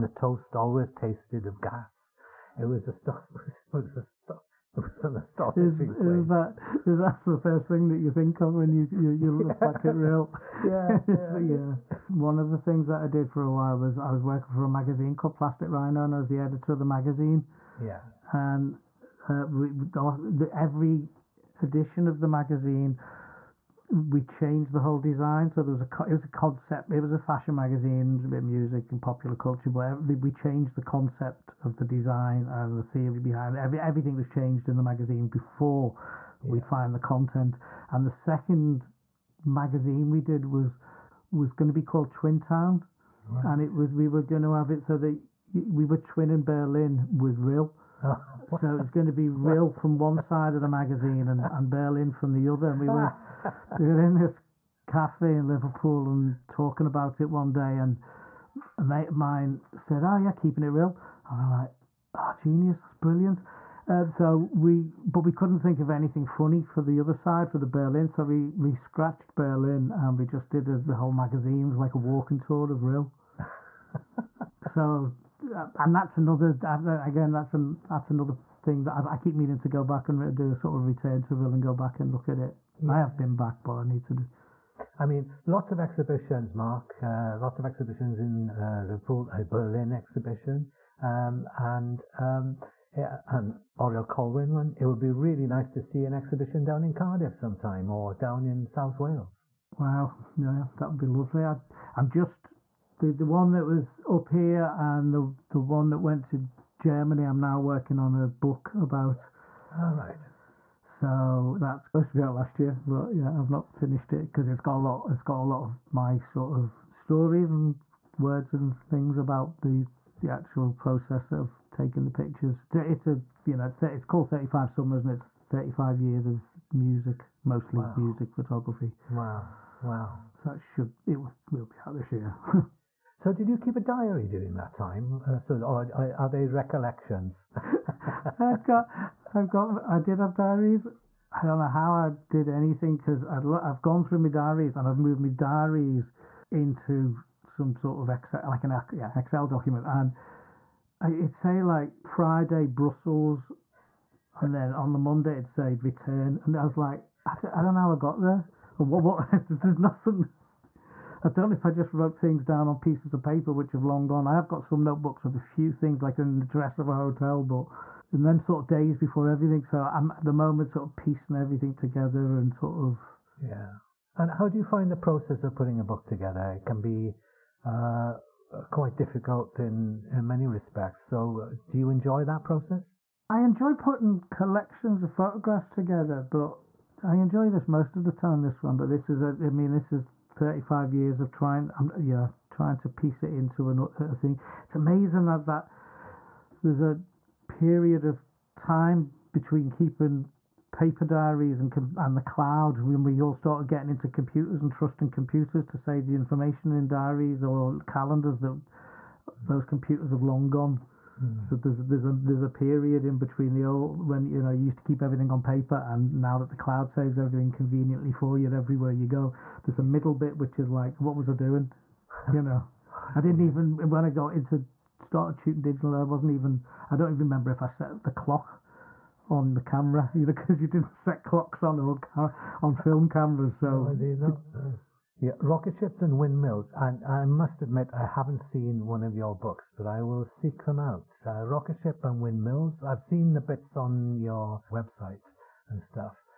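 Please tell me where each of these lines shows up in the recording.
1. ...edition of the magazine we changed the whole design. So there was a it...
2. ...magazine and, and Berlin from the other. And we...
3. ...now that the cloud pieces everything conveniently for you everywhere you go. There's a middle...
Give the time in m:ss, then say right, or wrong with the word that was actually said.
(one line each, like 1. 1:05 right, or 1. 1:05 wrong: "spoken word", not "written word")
1. 0:21 right
2. 0:50 right
3. 3:36 wrong: "saves", not "pieces".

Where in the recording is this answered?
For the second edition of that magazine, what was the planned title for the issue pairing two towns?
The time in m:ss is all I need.
0:42.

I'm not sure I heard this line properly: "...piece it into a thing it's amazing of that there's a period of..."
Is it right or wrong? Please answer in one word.
right.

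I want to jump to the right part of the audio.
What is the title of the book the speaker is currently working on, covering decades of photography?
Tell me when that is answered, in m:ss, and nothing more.
2:04.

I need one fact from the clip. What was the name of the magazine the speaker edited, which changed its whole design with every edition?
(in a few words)
Plastic Rhino.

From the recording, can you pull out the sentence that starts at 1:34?
It would be really nice to see an exhibition down in Cardiff sometime, or down in South Wales.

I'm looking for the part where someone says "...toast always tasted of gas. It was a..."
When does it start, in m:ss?
0:00.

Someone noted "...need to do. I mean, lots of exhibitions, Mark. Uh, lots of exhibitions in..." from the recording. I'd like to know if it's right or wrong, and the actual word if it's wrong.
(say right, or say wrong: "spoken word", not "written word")
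right.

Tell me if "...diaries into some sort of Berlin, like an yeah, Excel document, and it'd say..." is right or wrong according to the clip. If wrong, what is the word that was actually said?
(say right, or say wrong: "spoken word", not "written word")
wrong: "Excel", not "Berlin".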